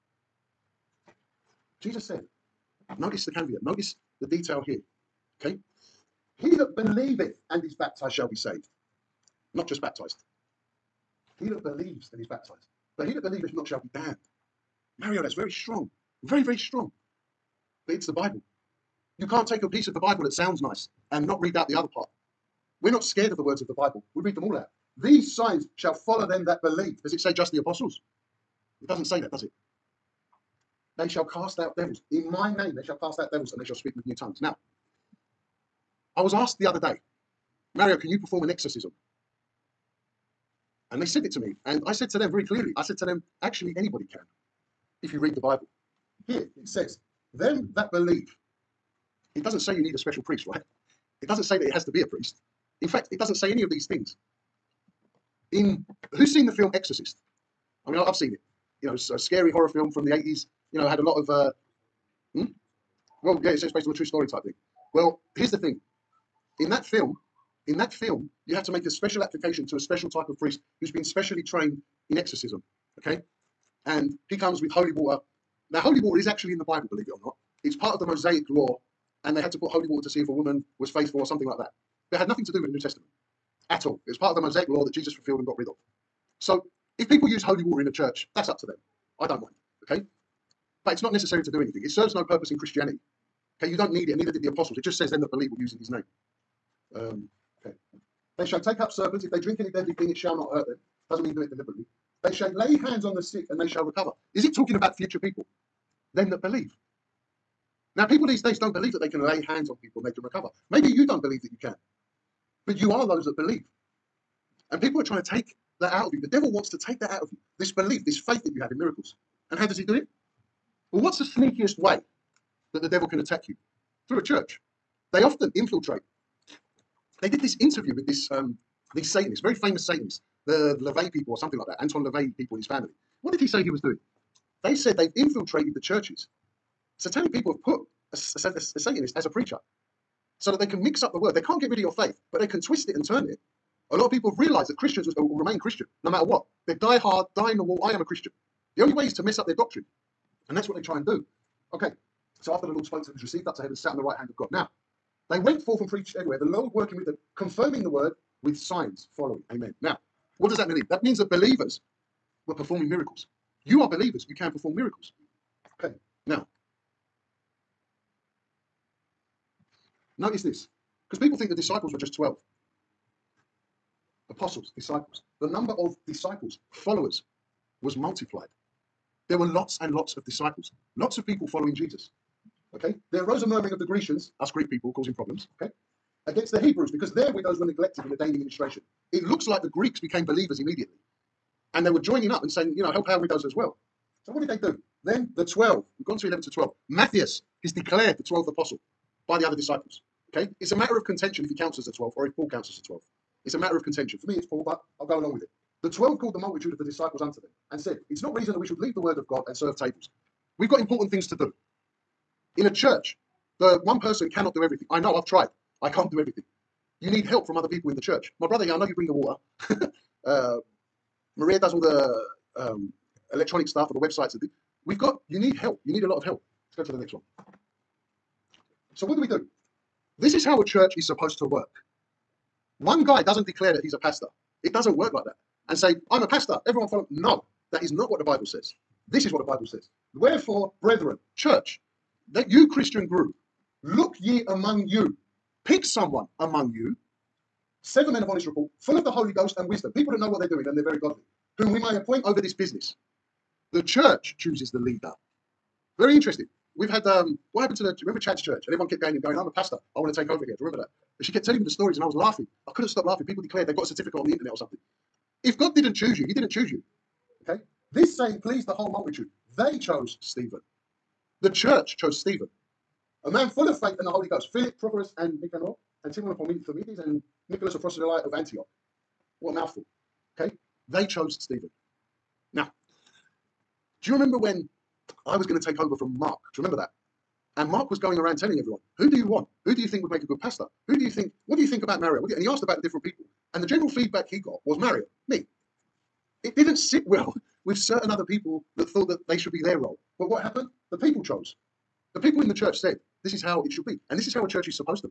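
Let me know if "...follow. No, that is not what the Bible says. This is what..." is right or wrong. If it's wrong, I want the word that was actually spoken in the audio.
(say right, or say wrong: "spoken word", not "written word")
right.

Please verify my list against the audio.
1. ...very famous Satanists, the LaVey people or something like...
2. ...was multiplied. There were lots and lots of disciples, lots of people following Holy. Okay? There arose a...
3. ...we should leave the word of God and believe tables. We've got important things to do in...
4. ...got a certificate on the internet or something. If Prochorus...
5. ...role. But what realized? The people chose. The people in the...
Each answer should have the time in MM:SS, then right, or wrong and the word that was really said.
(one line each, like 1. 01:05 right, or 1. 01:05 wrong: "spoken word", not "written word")
1. 02:09 right
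2. 02:57 wrong: "Jesus", not "Holy"
3. 03:28 wrong: "serve", not "believe"
4. 04:23 wrong: "God", not "Prochorus"
5. 04:59 wrong: "happened", not "realized".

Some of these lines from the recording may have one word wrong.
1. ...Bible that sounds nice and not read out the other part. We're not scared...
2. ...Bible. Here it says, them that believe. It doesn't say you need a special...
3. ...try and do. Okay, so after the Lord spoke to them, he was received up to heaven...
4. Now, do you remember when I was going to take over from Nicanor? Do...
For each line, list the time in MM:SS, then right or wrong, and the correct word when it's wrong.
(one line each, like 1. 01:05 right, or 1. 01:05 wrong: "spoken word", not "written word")
1. 00:19 right
2. 00:45 right
3. 02:30 right
4. 04:42 wrong: "Mark", not "Nicanor".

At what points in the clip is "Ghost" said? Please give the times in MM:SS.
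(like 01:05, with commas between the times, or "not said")
04:09, 04:34.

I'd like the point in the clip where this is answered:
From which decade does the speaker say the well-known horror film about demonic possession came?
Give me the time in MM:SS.
01:00.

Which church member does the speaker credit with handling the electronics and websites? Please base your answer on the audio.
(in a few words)
Maria.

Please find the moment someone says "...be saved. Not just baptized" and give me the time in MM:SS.
00:08.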